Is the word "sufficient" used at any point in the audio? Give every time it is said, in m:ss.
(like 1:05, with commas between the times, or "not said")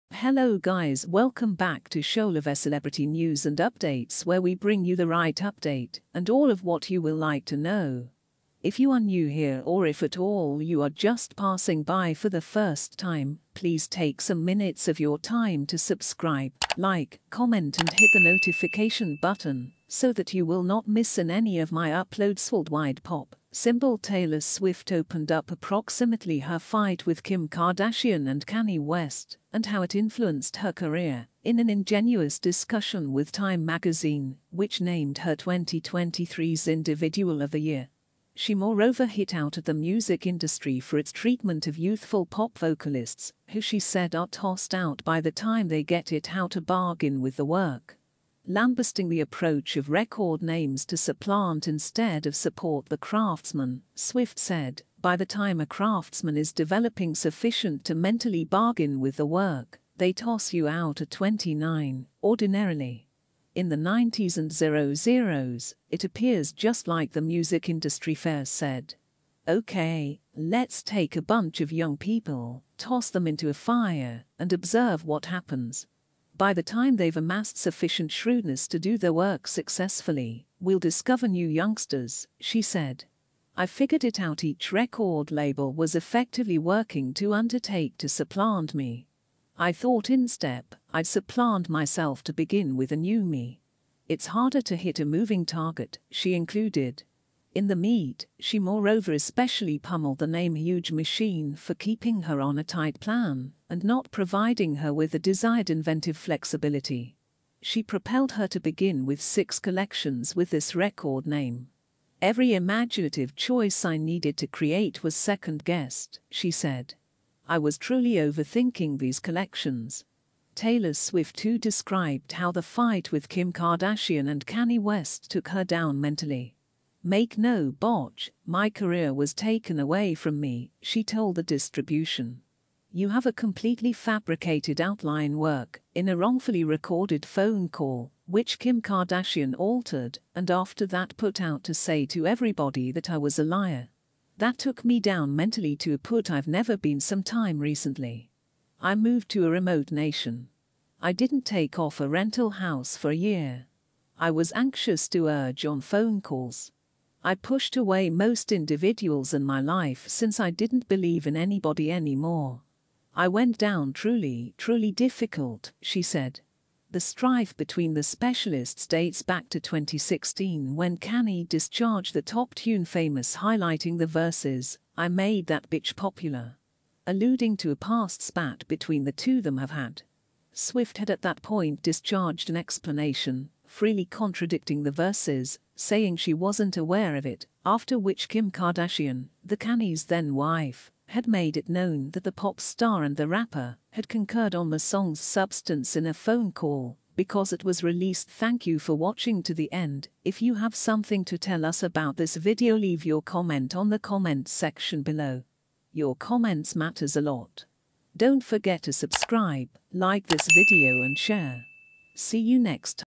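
0:57, 1:17.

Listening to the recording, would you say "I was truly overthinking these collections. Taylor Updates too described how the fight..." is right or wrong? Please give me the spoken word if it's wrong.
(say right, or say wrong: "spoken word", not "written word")
wrong: "Swift", not "Updates".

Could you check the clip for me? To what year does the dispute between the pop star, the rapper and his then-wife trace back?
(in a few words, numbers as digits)
2016.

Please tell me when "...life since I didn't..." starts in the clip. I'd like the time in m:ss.
2:39.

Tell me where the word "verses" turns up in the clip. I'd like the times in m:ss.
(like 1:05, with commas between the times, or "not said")
2:54, 3:04.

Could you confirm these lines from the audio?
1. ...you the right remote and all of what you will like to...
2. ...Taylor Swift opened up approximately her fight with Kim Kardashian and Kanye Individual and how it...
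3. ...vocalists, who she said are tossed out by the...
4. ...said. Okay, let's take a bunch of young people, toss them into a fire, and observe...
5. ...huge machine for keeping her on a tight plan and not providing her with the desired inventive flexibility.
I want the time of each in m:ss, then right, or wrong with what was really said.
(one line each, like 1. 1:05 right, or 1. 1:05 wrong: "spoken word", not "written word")
1. 0:04 wrong: "update", not "remote"
2. 0:23 wrong: "West", not "Individual"
3. 0:42 right
4. 1:08 right
5. 1:40 right.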